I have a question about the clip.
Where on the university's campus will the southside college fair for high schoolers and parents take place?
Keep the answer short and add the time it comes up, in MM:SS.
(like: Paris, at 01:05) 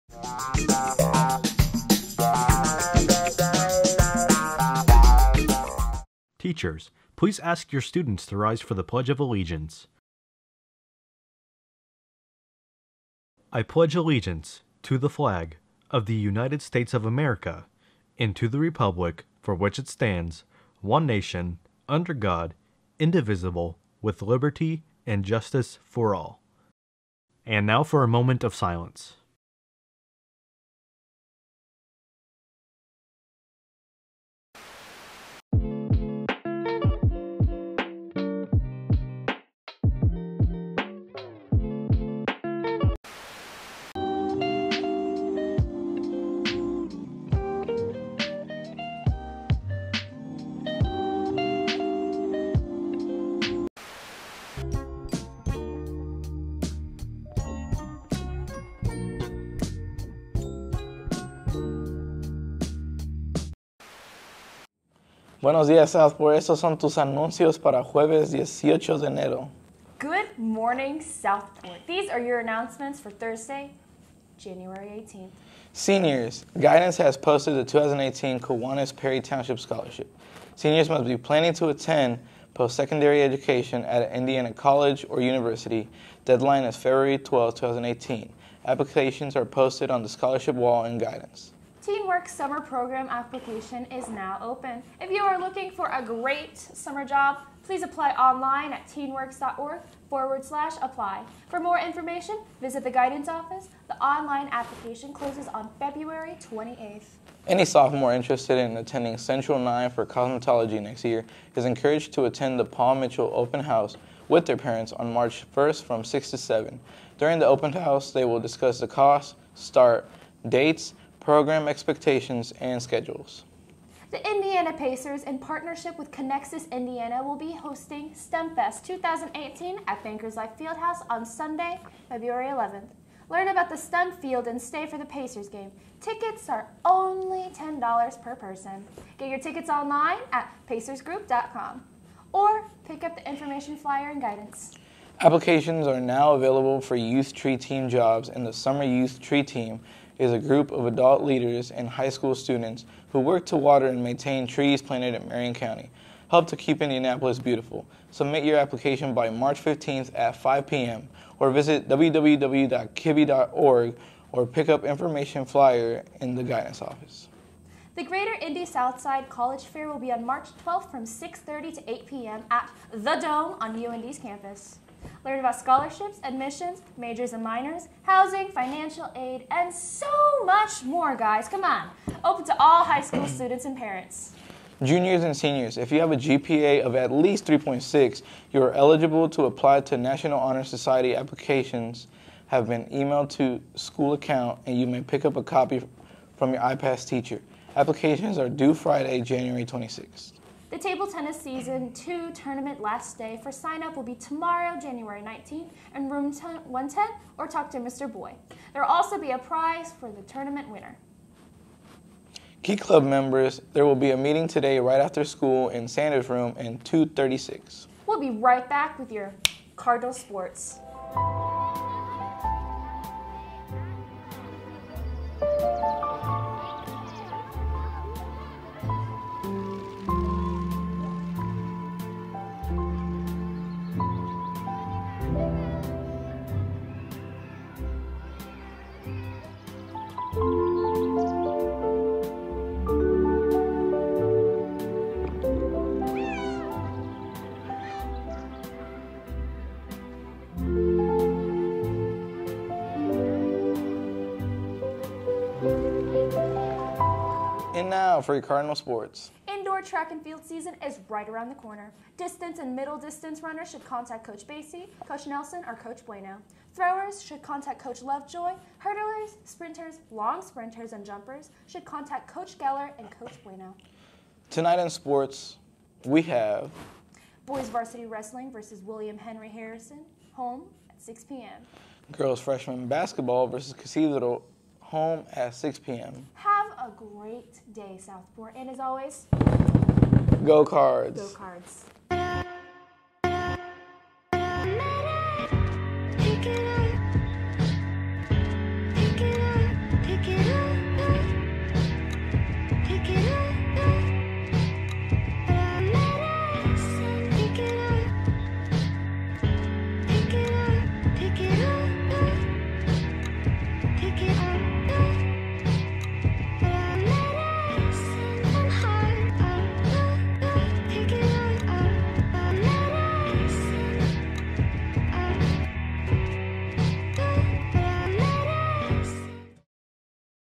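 The Dome, at 02:52.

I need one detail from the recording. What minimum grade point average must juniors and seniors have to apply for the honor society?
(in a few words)
3.6.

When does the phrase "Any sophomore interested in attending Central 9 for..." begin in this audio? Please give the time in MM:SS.
01:47.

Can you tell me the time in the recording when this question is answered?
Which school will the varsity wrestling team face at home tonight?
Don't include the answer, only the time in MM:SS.
04:38.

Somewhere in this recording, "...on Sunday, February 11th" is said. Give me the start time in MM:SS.
02:11.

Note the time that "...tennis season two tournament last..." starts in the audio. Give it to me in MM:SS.
03:21.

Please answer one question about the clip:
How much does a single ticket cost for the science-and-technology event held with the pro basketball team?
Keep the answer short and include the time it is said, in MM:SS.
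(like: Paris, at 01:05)
$10, at 02:17.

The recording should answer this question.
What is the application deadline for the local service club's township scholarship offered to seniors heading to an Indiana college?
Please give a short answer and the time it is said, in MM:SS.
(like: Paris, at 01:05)
February 12, 2018, at 01:26.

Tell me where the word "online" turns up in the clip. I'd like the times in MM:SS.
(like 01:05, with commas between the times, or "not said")
01:38, 01:43, 02:19.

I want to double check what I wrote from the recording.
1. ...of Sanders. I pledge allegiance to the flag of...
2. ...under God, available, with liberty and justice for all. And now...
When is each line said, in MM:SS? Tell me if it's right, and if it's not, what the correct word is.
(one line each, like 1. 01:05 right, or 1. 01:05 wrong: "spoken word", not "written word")
1. 00:09 wrong: "Allegiance", not "Sanders"
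2. 00:21 wrong: "indivisible", not "available".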